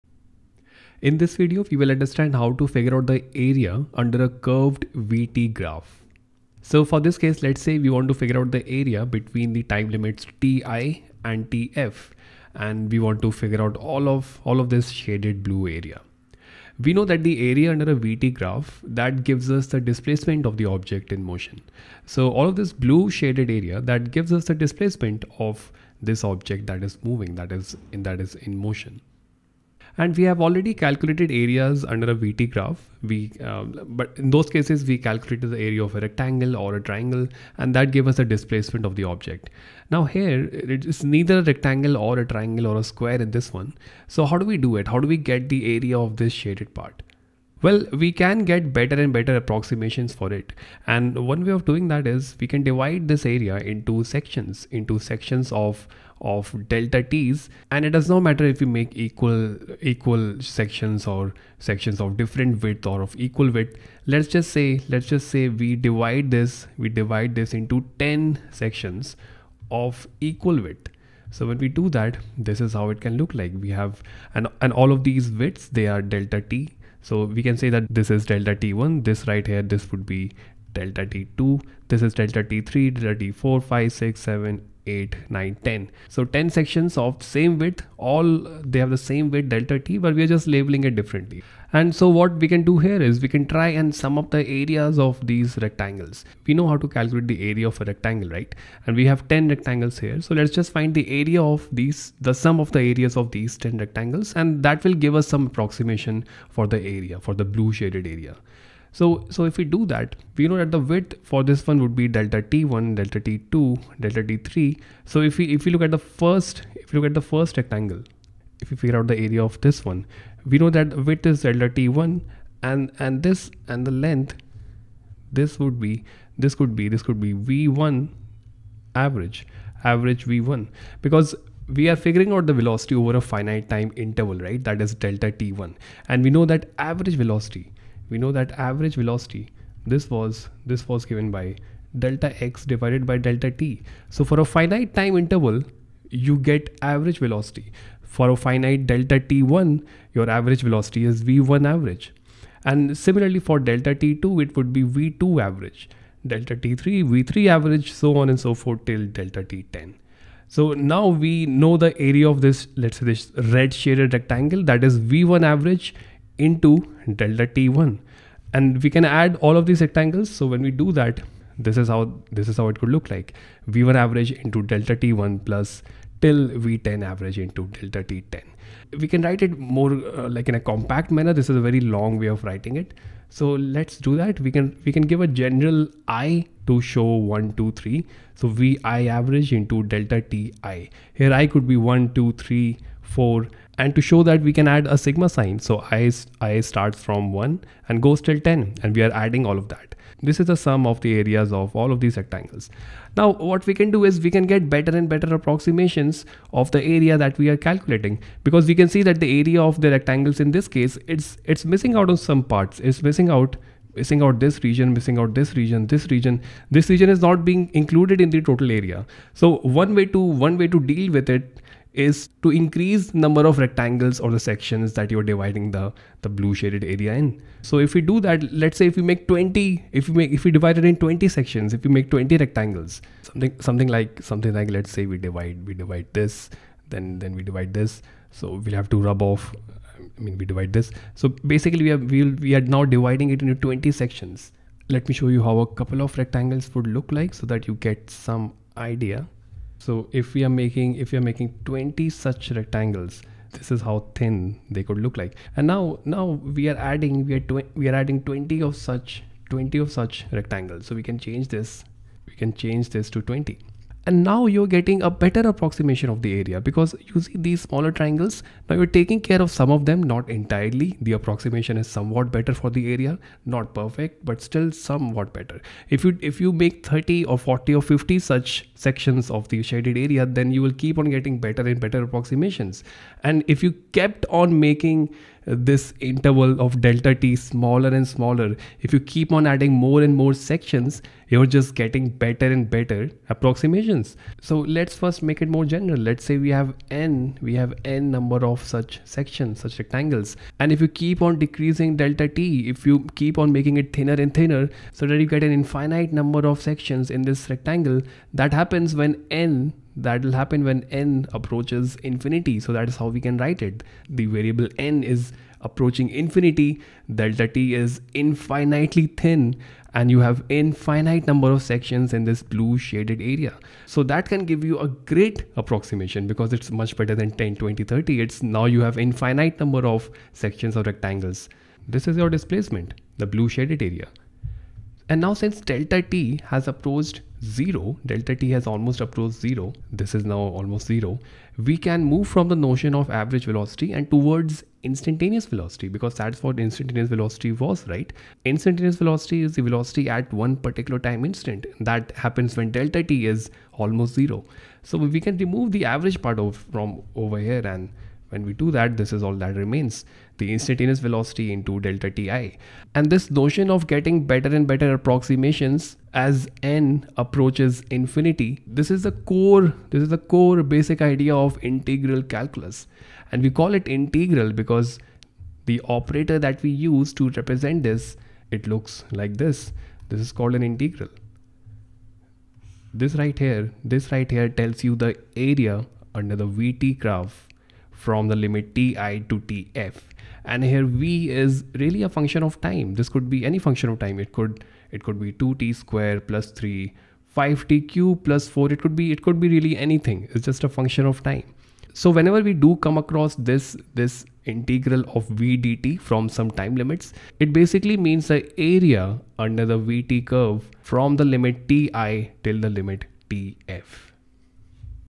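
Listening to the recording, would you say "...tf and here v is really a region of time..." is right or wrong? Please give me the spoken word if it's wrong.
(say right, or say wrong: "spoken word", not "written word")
wrong: "function", not "region".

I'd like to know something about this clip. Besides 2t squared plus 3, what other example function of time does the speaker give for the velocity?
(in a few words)
5t cubed plus 4.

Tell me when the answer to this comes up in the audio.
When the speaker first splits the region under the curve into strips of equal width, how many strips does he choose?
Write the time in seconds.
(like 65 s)
67 s.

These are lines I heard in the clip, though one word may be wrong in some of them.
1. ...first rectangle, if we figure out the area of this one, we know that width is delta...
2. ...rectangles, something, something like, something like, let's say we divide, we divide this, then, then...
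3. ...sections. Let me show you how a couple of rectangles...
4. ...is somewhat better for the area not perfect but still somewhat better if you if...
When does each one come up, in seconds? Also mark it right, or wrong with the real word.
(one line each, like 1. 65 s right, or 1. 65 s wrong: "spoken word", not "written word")
1. 117 s right
2. 232 s right
3. 243 s right
4. 271 s right.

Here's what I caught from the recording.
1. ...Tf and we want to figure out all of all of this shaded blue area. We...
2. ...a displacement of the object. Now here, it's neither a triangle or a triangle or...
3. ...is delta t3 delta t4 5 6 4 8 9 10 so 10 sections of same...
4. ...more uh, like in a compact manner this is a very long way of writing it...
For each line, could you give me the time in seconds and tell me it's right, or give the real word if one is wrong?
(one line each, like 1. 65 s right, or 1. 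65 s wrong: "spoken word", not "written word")
1. 11 s right
2. 38 s wrong: "rectangle", not "triangle"
3. 82 s wrong: "7", not "4"
4. 179 s right.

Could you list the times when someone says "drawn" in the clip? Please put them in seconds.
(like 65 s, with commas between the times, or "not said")
not said.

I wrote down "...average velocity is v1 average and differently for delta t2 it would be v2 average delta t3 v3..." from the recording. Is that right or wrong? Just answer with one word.
wrong.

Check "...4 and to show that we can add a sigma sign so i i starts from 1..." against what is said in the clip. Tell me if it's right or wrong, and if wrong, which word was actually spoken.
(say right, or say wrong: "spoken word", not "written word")
right.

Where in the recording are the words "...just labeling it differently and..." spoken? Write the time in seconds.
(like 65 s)
90 s.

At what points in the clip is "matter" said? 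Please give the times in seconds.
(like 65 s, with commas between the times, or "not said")
58 s.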